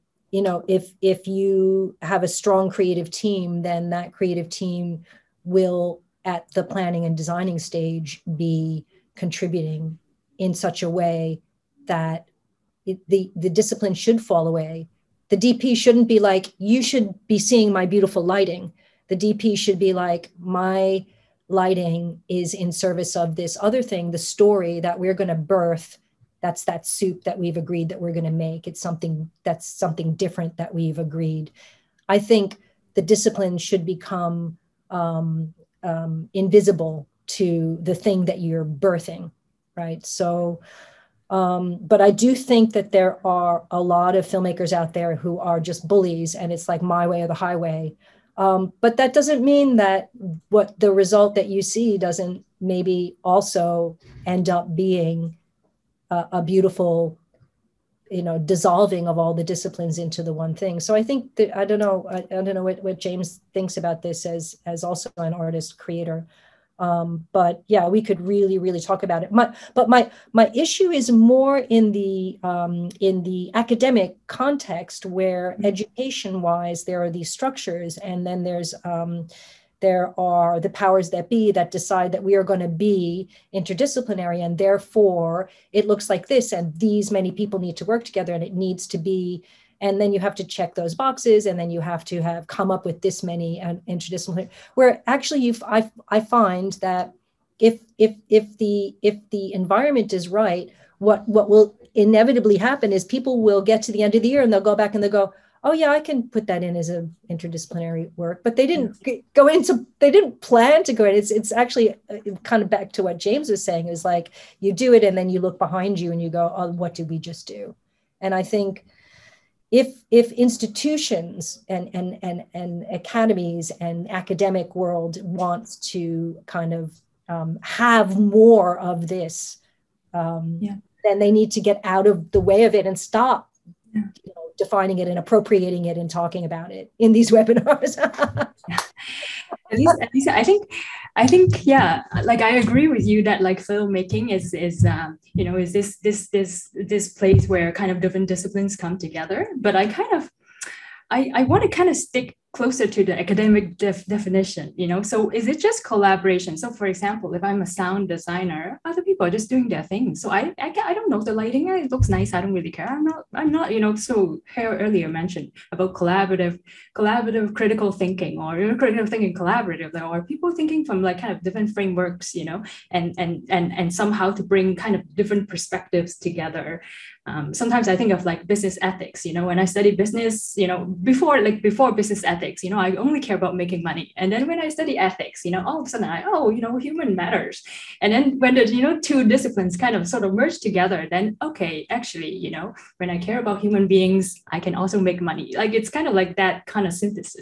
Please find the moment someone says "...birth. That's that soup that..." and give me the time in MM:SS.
00:25.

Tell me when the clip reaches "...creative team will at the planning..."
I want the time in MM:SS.
00:04.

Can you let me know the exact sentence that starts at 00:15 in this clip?
The DP shouldn't be like, you should be seeing my beautiful lighting.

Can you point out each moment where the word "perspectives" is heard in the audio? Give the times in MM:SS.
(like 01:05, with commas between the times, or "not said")
02:55.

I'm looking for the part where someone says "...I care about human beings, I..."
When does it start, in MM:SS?
03:13.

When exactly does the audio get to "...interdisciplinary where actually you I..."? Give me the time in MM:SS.
01:33.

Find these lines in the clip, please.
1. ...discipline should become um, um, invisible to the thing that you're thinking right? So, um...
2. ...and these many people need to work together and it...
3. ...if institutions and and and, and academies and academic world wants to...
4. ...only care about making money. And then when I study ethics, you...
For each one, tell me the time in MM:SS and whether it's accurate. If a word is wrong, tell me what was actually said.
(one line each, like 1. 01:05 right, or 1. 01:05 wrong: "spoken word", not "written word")
1. 00:33 wrong: "birthing", not "thinking"
2. 01:26 right
3. 02:00 right
4. 03:02 right.